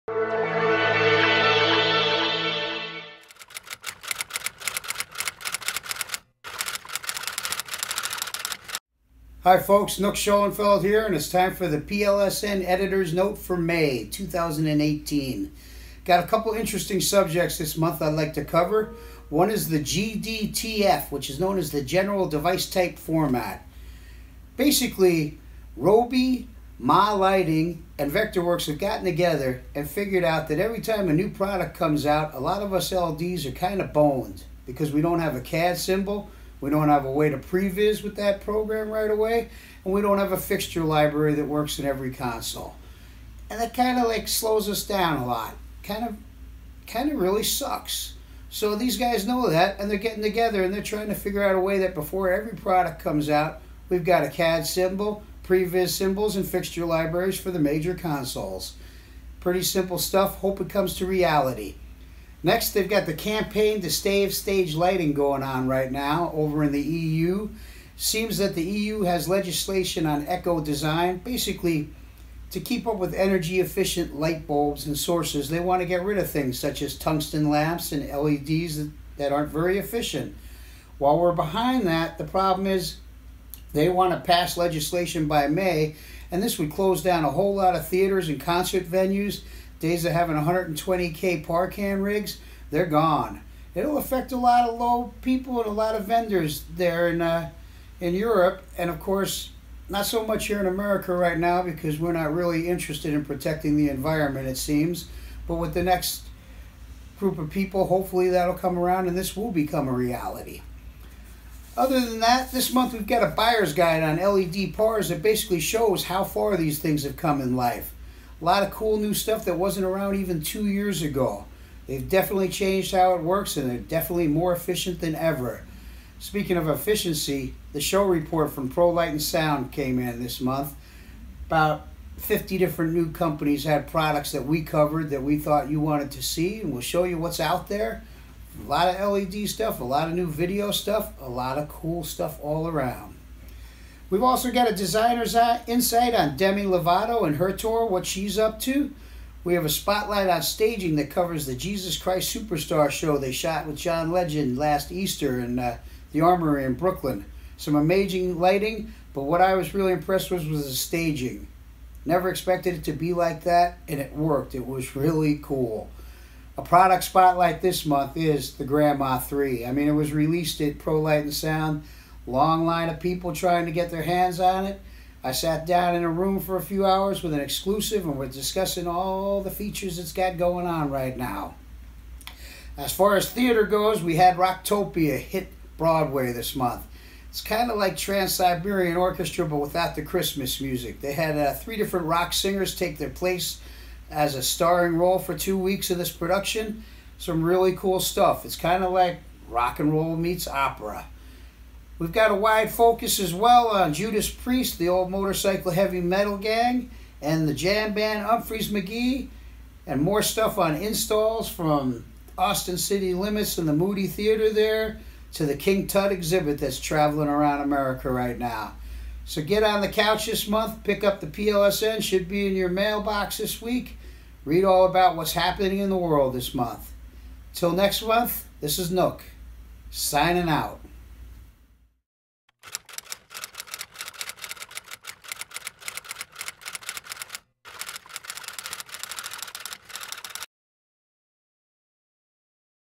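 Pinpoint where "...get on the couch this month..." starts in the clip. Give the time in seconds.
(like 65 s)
219 s.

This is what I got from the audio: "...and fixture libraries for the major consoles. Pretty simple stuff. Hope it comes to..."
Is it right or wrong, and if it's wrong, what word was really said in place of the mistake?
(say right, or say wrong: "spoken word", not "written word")
right.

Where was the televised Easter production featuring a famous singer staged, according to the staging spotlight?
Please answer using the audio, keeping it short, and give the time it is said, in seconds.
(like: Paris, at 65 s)
The Armory in Brooklyn, at 156 s.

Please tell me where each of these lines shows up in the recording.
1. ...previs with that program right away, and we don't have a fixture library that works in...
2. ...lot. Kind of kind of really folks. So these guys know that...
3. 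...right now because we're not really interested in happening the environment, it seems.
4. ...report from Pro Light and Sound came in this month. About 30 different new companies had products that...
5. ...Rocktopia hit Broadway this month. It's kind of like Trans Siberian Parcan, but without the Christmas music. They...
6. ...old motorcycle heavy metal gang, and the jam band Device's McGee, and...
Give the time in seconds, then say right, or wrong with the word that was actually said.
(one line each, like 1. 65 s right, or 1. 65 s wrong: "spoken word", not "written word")
1. 37 s right
2. 45 s wrong: "sucks", not "folks"
3. 101 s wrong: "protecting", not "happening"
4. 128 s wrong: "50", not "30"
5. 184 s wrong: "Orchestra", not "Parcan"
6. 204 s wrong: "Umphrey", not "Device".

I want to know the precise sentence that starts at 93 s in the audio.
It'll affect a lot of low people and a lot of vendors there in, uh, in Europe.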